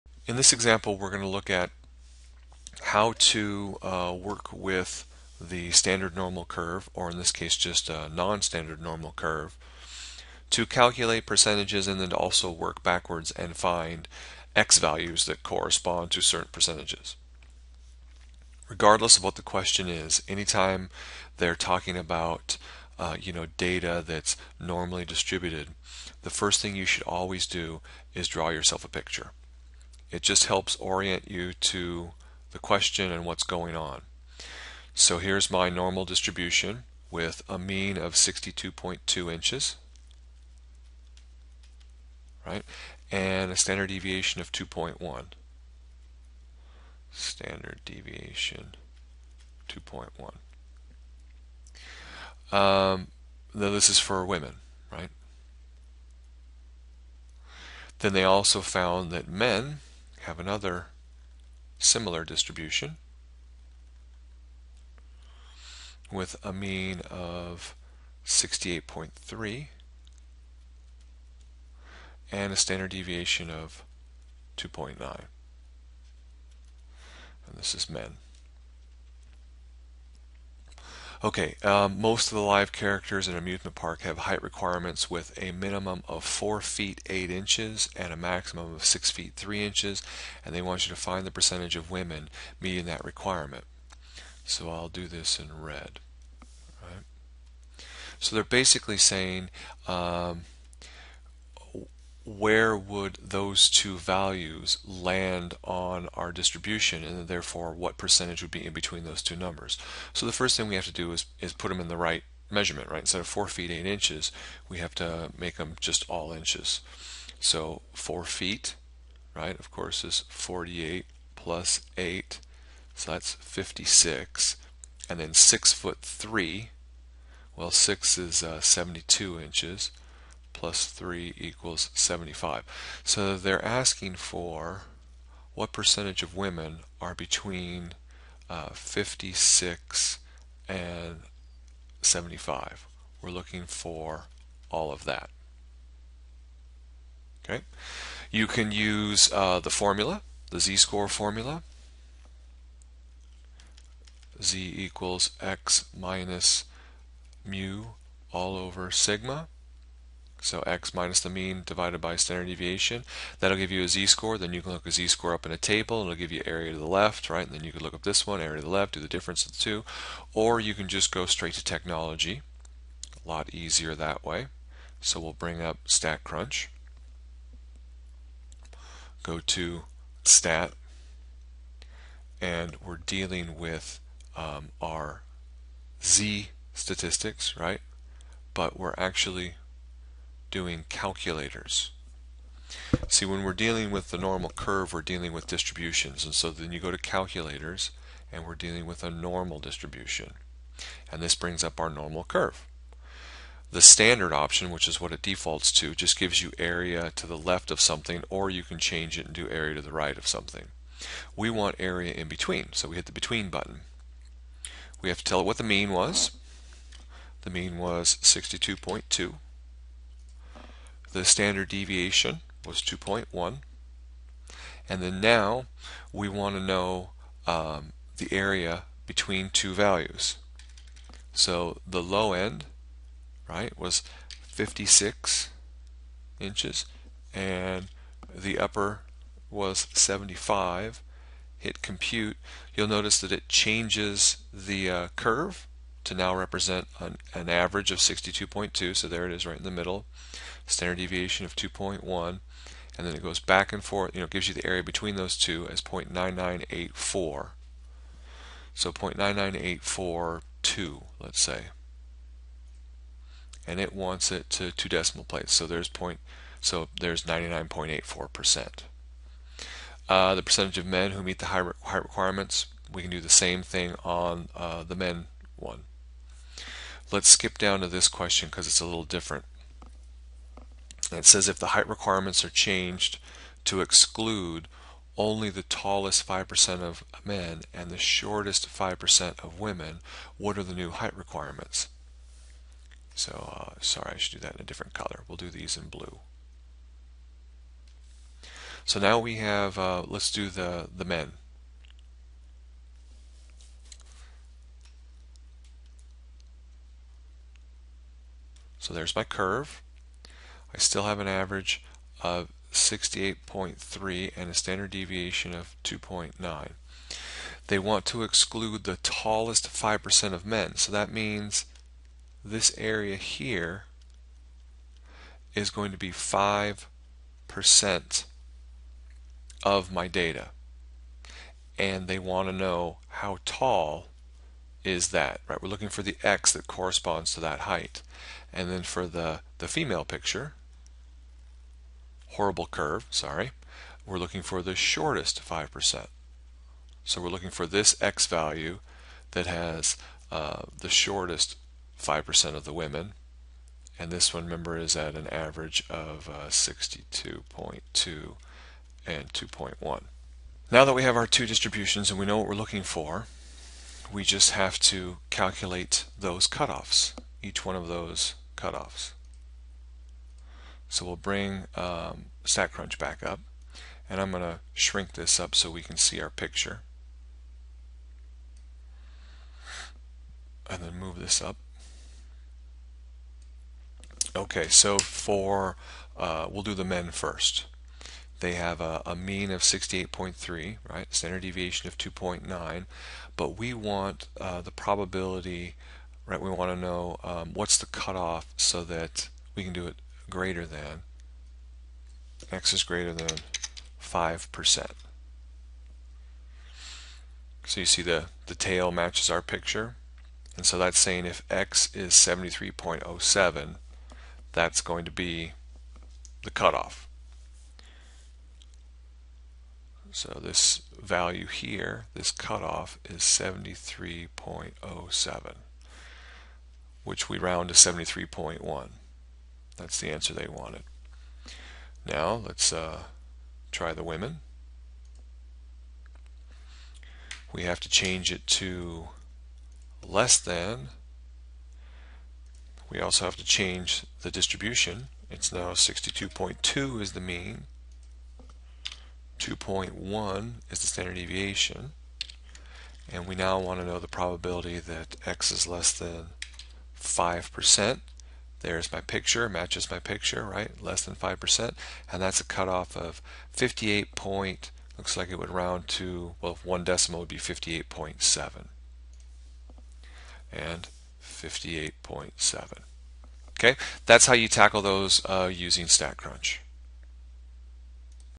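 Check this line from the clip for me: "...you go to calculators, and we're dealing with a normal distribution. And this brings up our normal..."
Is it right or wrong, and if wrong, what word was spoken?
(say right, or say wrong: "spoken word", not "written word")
right.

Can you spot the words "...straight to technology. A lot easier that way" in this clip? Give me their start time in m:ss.
2:51.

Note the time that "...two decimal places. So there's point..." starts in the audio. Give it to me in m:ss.
4:24.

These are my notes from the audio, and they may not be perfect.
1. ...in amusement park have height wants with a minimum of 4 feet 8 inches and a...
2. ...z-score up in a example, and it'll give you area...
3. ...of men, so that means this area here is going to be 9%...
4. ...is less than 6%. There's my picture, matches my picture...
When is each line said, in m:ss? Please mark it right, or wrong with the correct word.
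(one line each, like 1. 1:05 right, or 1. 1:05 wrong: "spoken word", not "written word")
1. 1:23 wrong: "requirements", not "wants"
2. 2:44 wrong: "table", not "example"
3. 5:20 wrong: "5", not "9"
4. 7:35 wrong: "5", not "6".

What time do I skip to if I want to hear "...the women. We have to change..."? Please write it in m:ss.
7:13.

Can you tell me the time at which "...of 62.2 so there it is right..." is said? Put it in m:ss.
4:07.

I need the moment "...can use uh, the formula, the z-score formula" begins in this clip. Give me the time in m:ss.
2:28.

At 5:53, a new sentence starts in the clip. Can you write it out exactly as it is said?
And this one, remember, is at an average of uh, 62.2 and 2.1.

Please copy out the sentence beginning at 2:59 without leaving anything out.
Go to Stat, and we're dealing with um, our z statistics, right?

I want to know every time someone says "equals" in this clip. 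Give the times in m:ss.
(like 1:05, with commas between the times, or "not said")
2:11, 2:34.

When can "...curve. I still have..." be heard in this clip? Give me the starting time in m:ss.
5:09.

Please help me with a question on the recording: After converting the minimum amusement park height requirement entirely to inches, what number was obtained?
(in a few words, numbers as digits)
56.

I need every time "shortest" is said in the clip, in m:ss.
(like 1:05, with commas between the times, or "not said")
4:47, 5:44, 5:50.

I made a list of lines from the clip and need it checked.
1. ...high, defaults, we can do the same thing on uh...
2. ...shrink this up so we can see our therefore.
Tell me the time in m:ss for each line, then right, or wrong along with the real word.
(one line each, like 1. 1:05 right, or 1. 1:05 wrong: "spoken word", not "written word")
1. 4:31 wrong: "requirements", not "defaults"
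2. 6:14 wrong: "picture", not "therefore".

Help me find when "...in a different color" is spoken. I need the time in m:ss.
4:54.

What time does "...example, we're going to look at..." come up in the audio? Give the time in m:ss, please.
0:00.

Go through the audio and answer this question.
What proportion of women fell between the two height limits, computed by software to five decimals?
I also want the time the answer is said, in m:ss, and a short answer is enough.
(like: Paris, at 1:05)
0.99842, at 4:18.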